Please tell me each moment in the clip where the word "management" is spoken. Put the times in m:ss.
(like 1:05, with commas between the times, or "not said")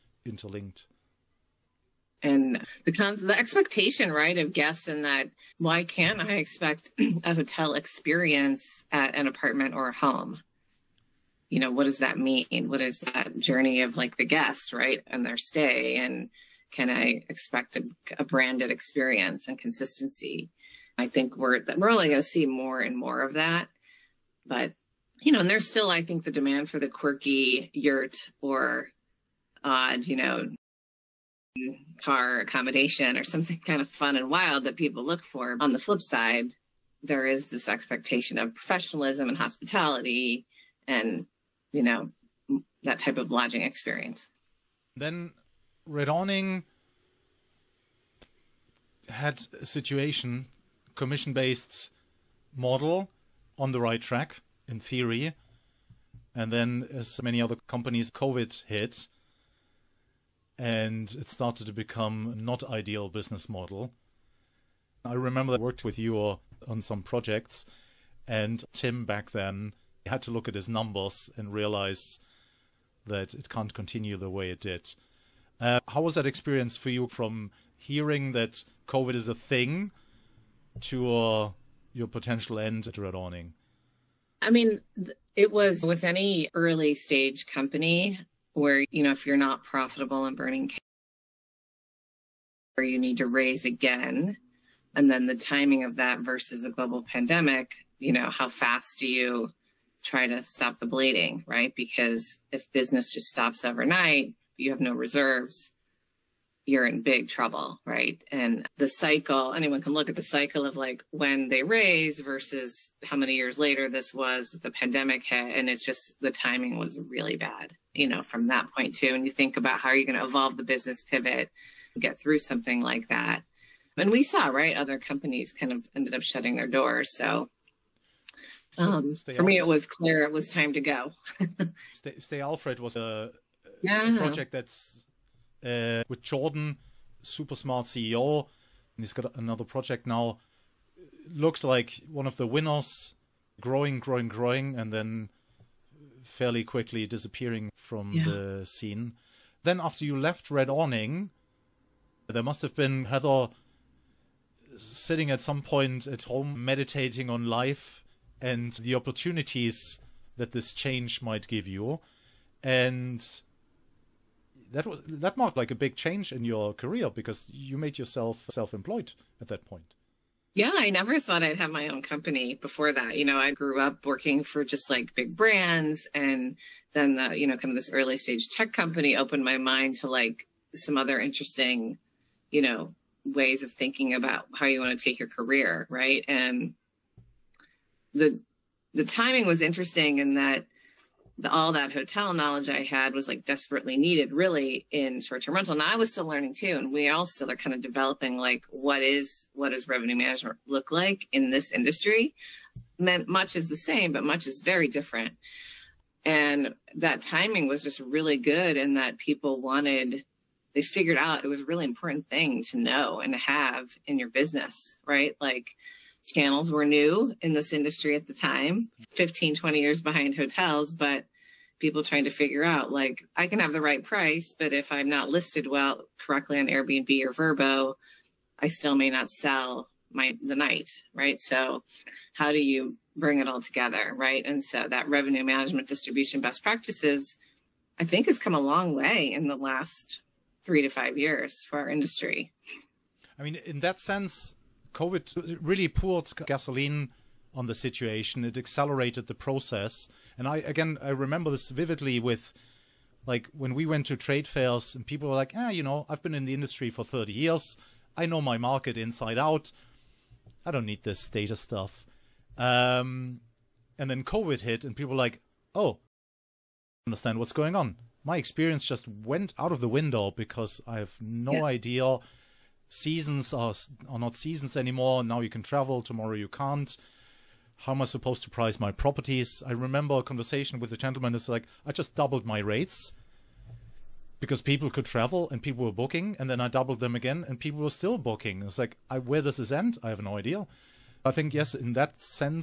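3:20, 3:55.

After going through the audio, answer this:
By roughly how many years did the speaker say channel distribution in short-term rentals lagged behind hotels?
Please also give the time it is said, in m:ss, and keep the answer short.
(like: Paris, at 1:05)
15-20 years, at 3:39.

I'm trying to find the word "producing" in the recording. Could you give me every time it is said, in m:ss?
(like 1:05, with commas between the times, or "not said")
not said.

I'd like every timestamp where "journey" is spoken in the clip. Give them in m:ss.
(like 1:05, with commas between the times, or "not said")
0:13.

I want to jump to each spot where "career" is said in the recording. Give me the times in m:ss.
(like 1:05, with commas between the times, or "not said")
2:46, 3:05.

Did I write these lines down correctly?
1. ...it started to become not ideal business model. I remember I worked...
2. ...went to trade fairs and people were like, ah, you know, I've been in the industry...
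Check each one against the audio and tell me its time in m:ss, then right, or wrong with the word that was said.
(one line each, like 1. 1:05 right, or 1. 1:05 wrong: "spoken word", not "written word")
1. 1:01 right
2. 4:13 right.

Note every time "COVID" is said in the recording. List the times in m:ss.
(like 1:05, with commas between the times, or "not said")
0:58, 1:18, 4:04, 4:24.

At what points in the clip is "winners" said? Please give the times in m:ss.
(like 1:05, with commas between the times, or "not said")
2:22.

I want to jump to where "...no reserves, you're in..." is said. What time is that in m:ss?
1:44.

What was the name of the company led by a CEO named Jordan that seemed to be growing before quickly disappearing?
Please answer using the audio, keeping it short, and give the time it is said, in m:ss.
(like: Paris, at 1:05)
Stay Alfred, at 2:12.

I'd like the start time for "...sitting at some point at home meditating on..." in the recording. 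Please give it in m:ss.
2:34.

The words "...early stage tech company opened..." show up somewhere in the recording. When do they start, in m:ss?
2:57.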